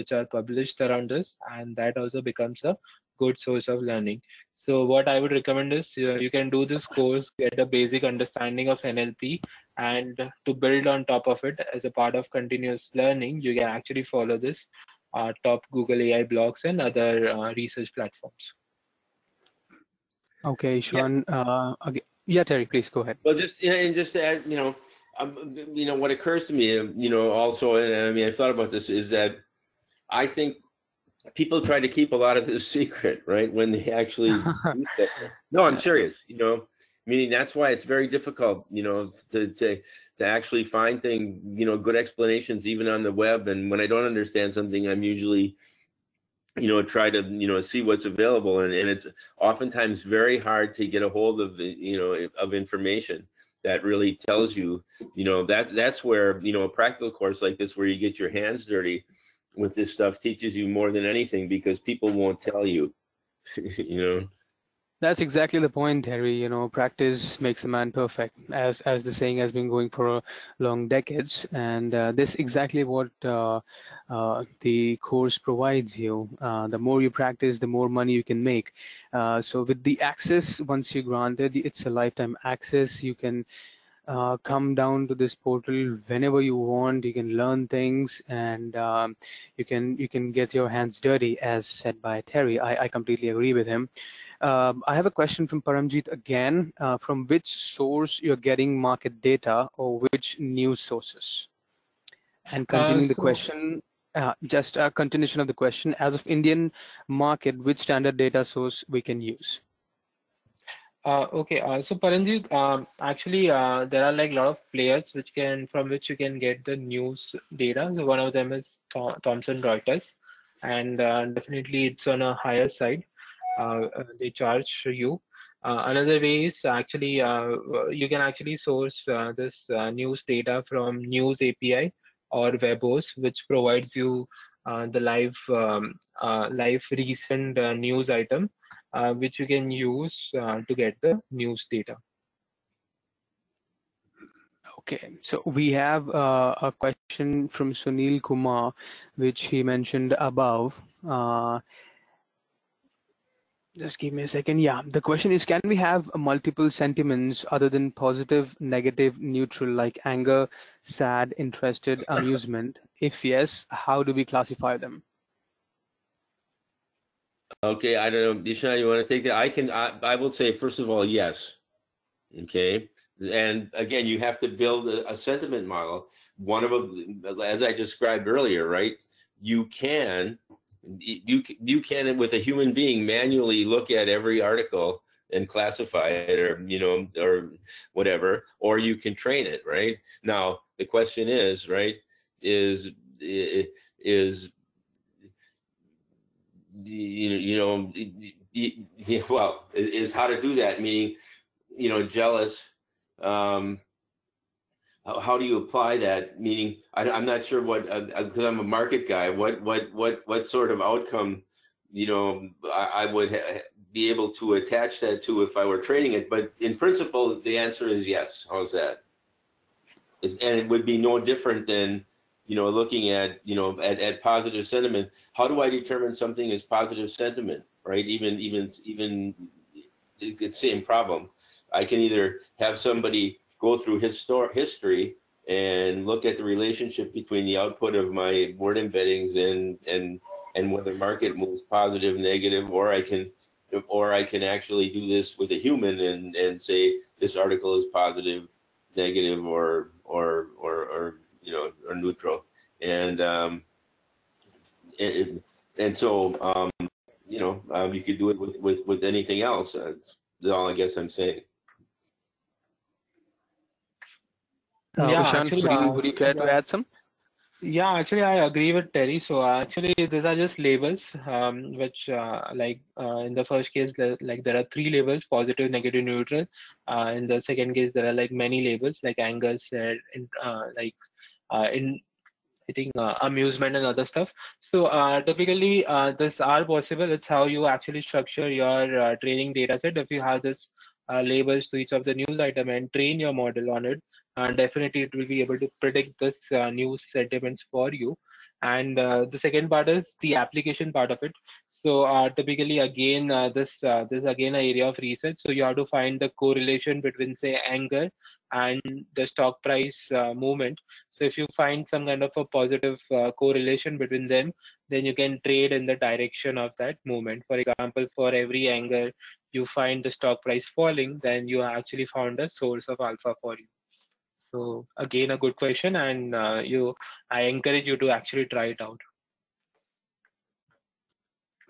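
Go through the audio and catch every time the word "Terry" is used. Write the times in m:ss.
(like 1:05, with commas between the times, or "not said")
0:22, 1:06, 1:32, 4:28.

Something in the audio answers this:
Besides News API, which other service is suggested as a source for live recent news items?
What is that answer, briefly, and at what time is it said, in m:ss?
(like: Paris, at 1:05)
Webhose, at 2:12.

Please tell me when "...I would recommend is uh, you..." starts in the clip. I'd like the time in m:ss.
0:05.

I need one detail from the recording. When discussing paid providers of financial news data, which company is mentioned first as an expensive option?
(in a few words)
Thomson Reuters.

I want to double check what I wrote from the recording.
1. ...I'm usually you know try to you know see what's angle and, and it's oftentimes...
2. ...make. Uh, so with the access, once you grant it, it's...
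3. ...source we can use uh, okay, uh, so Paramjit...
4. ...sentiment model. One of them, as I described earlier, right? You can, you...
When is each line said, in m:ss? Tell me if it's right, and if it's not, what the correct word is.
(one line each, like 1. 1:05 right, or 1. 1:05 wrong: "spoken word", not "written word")
1. 0:44 wrong: "available", not "angle"
2. 1:18 right
3. 1:48 right
4. 2:55 right.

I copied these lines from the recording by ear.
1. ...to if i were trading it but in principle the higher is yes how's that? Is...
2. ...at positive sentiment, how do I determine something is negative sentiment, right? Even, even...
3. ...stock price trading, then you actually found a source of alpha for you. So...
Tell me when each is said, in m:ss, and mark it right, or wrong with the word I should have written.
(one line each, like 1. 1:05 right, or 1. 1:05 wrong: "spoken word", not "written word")
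1. 3:35 wrong: "answer", not "higher"
2. 3:43 wrong: "positive", not "negative"
3. 5:20 wrong: "falling", not "trading".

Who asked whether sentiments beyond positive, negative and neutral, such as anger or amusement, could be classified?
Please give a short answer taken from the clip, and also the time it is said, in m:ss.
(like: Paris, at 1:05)
Sunil Kumar, at 2:27.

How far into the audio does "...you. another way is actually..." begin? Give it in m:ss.
2:04.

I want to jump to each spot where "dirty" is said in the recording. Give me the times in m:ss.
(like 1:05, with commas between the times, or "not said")
0:58, 1:31.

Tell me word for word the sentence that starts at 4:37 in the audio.
in the second case, there are like many labels, like anger said, like uh, in I think uh, amusement and other stuff.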